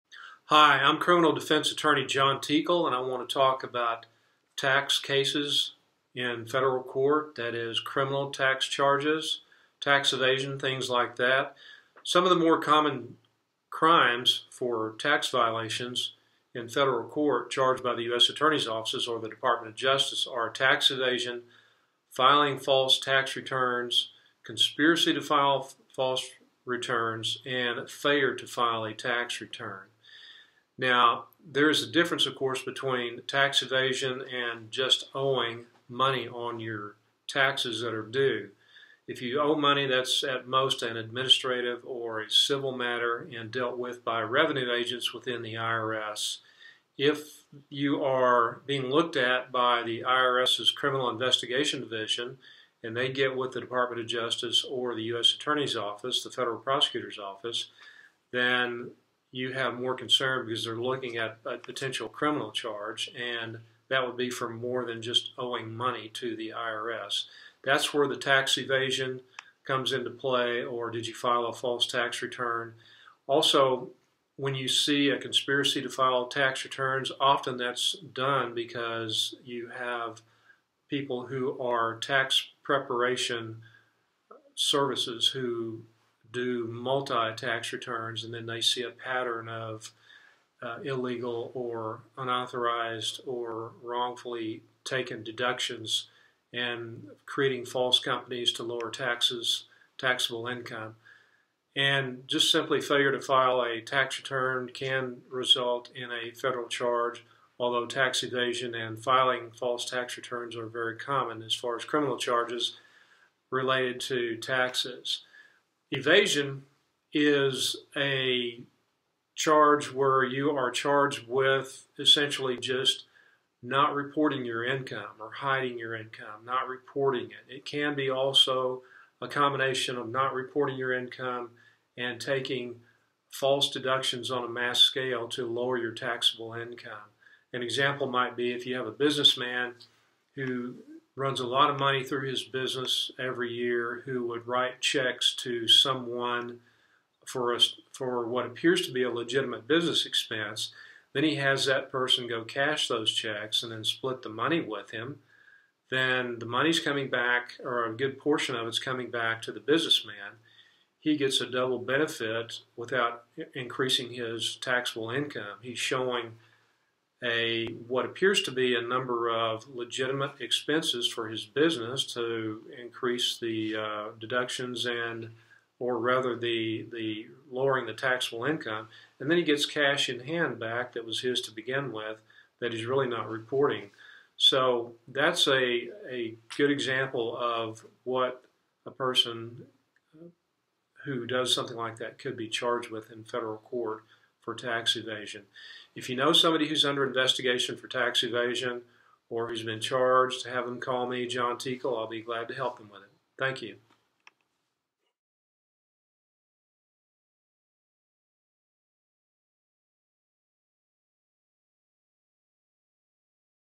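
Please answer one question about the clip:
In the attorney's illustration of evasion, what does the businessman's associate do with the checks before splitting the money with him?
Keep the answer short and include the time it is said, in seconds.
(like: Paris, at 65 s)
cash those checks, at 152 s.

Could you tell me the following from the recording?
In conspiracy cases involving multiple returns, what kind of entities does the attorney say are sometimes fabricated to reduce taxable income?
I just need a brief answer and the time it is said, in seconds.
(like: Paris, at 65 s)
false companies, at 97 s.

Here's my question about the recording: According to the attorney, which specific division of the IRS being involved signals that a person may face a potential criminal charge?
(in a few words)
Criminal Investigation Division.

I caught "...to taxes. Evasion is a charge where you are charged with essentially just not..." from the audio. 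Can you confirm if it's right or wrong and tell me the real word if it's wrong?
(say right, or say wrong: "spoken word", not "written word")
right.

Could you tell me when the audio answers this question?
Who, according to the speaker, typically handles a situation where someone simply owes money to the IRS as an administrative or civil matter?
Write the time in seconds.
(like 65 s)
44 s.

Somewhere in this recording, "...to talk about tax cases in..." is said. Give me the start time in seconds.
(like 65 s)
3 s.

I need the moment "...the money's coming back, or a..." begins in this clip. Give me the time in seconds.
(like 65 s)
156 s.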